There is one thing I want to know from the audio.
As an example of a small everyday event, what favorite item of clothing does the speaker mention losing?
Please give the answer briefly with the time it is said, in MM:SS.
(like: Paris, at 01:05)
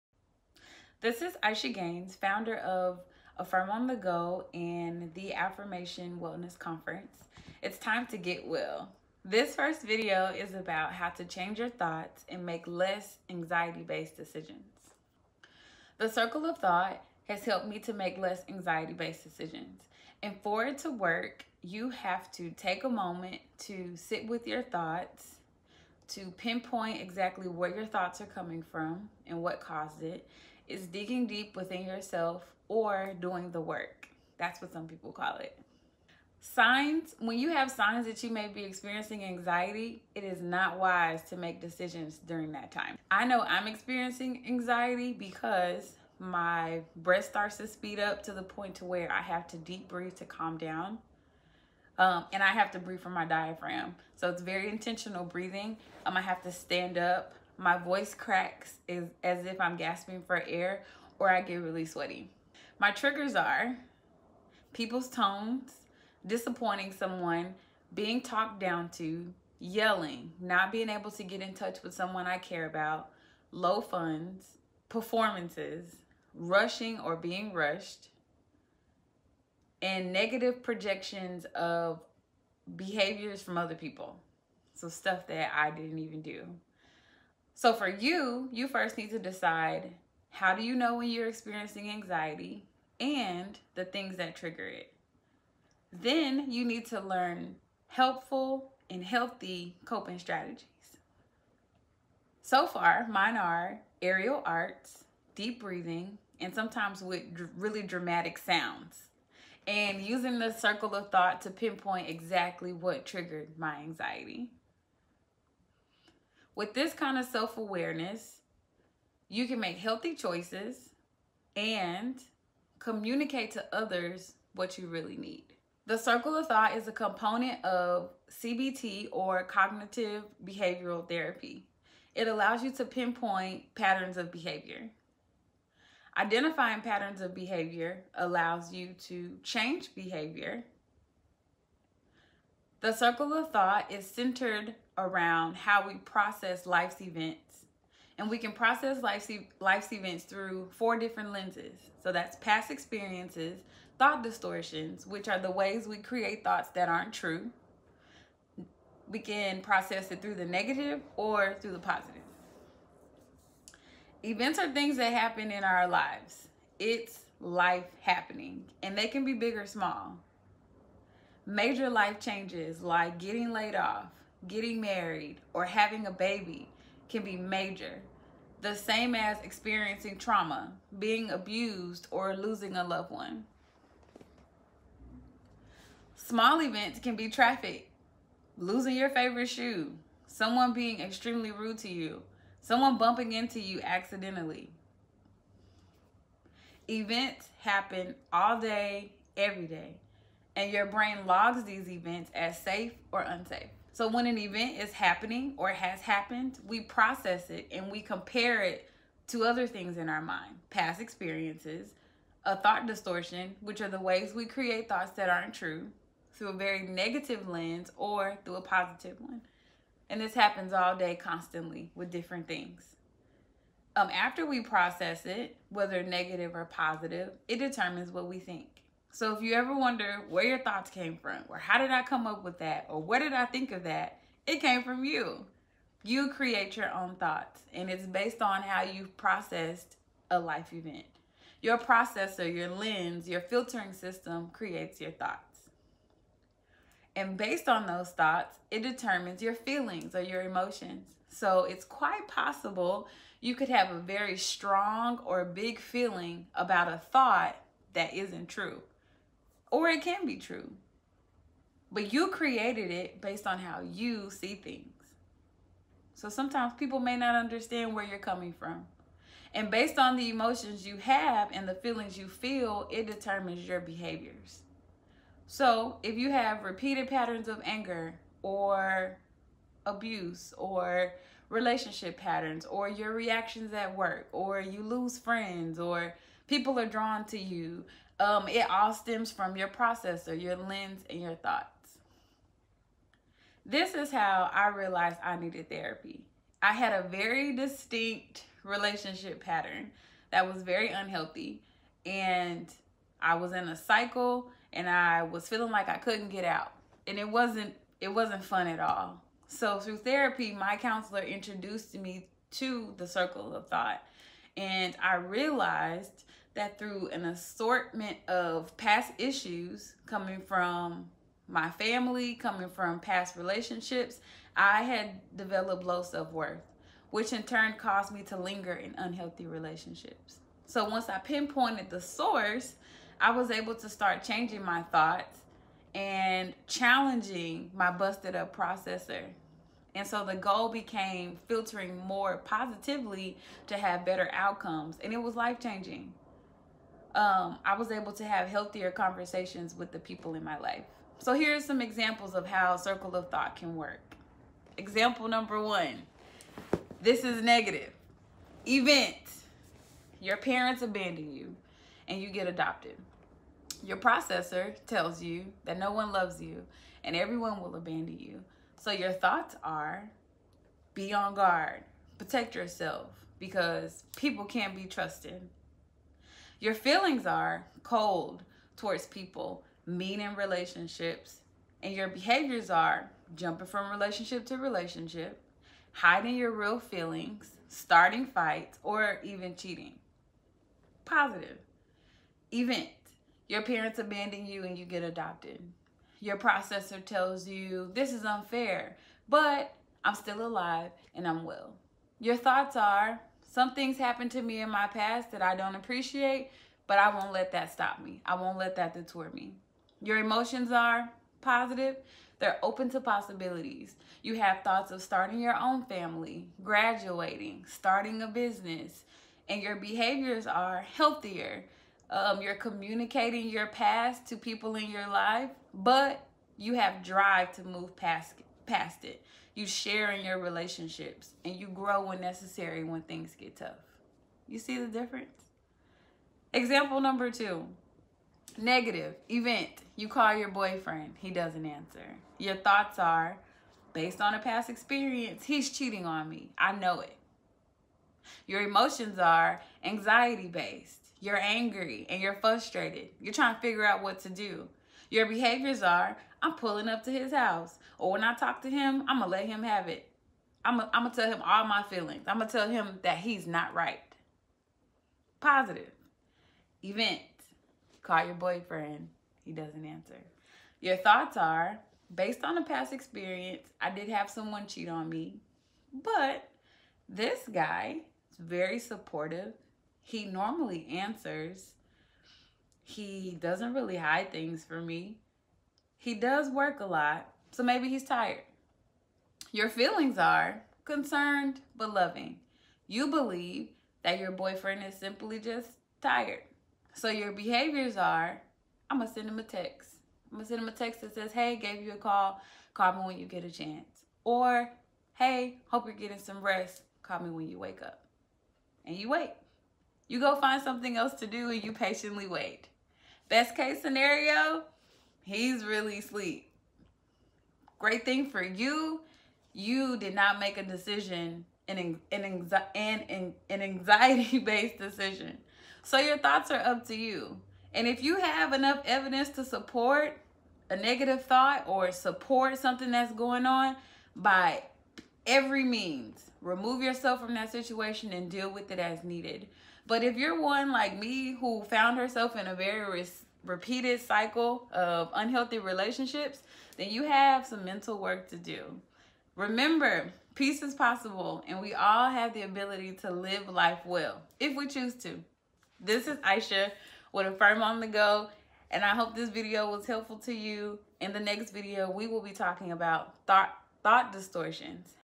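Shoe, at 03:09.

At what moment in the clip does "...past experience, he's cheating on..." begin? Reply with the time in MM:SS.
07:24.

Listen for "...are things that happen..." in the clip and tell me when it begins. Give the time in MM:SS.
02:44.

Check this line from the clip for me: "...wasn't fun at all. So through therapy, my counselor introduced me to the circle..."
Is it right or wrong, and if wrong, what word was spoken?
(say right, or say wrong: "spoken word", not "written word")
right.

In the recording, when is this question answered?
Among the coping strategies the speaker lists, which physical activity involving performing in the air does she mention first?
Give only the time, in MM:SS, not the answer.
01:44.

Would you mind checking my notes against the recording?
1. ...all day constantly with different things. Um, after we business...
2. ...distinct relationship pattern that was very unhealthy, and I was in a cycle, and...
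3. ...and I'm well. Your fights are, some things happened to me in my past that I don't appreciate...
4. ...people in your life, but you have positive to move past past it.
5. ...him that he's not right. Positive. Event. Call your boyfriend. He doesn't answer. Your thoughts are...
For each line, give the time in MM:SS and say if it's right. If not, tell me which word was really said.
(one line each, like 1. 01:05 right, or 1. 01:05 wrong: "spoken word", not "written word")
1. 03:40 wrong: "process", not "business"
2. 04:57 right
3. 06:41 wrong: "thoughts", not "fights"
4. 07:04 wrong: "drive", not "positive"
5. 07:42 right.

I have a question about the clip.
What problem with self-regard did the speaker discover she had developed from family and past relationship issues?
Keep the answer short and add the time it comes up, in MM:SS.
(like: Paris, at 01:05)
Low self worth, at 05:25.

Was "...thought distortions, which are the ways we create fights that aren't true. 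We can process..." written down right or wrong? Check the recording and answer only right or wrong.
wrong.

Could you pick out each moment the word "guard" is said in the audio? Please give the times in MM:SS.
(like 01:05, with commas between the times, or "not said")
06:11.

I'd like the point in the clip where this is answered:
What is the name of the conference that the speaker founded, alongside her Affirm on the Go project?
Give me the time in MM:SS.
00:05.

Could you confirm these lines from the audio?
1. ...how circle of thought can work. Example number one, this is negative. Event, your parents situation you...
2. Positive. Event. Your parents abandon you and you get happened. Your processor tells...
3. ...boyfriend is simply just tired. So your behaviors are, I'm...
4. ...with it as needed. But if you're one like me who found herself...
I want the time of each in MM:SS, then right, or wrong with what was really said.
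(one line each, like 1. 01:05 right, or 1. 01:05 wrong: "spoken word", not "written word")
1. 05:52 wrong: "abandon", not "situation"
2. 06:31 wrong: "adopted", not "happened"
3. 08:14 right
4. 08:58 right.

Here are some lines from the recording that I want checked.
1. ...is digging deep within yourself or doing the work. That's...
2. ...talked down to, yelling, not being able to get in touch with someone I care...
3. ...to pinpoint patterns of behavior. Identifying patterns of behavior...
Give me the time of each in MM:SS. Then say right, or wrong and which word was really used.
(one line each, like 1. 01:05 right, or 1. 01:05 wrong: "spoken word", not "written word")
1. 00:30 right
2. 01:08 right
3. 02:12 right.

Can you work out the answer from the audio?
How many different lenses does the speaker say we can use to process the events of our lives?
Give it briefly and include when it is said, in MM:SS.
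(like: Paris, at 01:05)
4, at 02:30.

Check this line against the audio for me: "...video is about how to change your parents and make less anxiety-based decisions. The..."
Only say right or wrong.
wrong.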